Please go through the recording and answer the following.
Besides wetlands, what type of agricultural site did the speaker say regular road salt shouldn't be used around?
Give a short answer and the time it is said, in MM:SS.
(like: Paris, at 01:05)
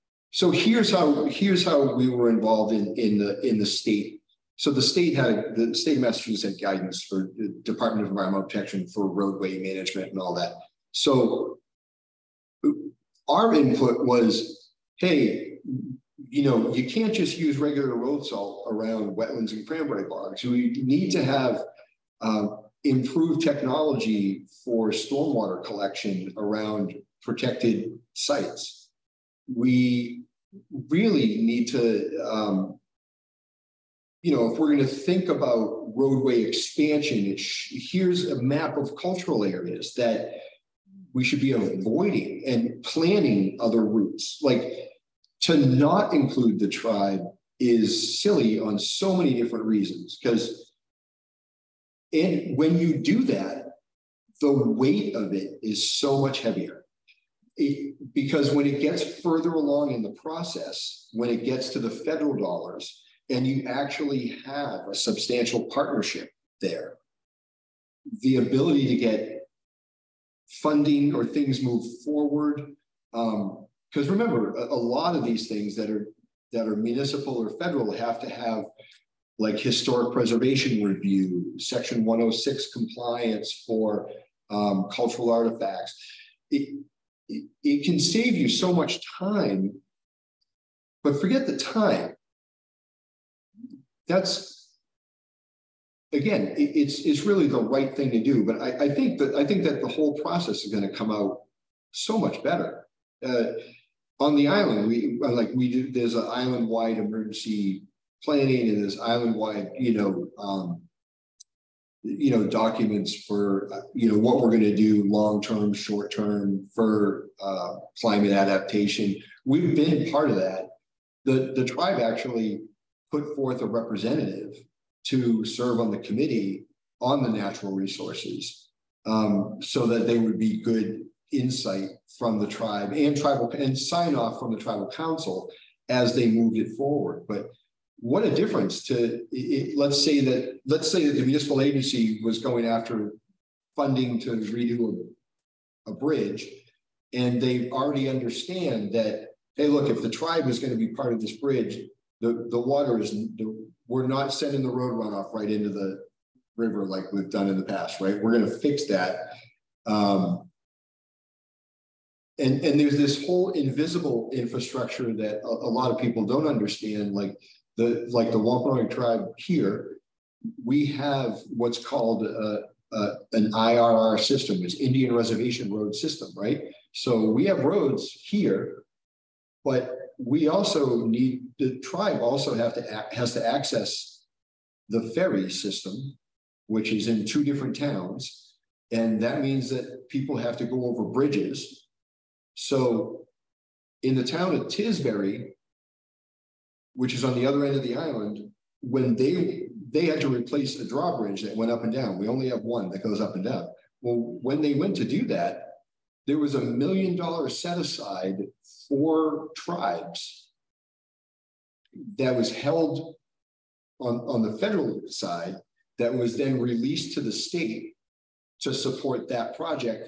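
Cranberry bogs, at 00:19.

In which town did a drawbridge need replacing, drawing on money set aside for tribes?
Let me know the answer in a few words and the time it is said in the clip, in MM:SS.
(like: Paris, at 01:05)
Tisbury, at 03:14.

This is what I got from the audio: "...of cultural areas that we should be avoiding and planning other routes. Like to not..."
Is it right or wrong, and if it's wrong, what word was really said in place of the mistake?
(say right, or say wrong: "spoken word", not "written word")
right.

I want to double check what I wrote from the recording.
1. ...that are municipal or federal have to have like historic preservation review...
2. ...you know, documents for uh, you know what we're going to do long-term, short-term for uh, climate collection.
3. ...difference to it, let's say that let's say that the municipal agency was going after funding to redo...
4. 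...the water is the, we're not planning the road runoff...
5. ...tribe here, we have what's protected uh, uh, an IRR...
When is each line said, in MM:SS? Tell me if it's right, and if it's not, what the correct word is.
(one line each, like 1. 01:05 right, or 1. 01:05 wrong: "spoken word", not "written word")
1. 01:16 right
2. 01:52 wrong: "adaptation", not "collection"
3. 02:18 right
4. 02:32 wrong: "sending", not "planning"
5. 02:48 wrong: "called", not "protected".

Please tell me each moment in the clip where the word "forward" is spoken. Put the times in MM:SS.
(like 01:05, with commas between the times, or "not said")
01:12, 02:16.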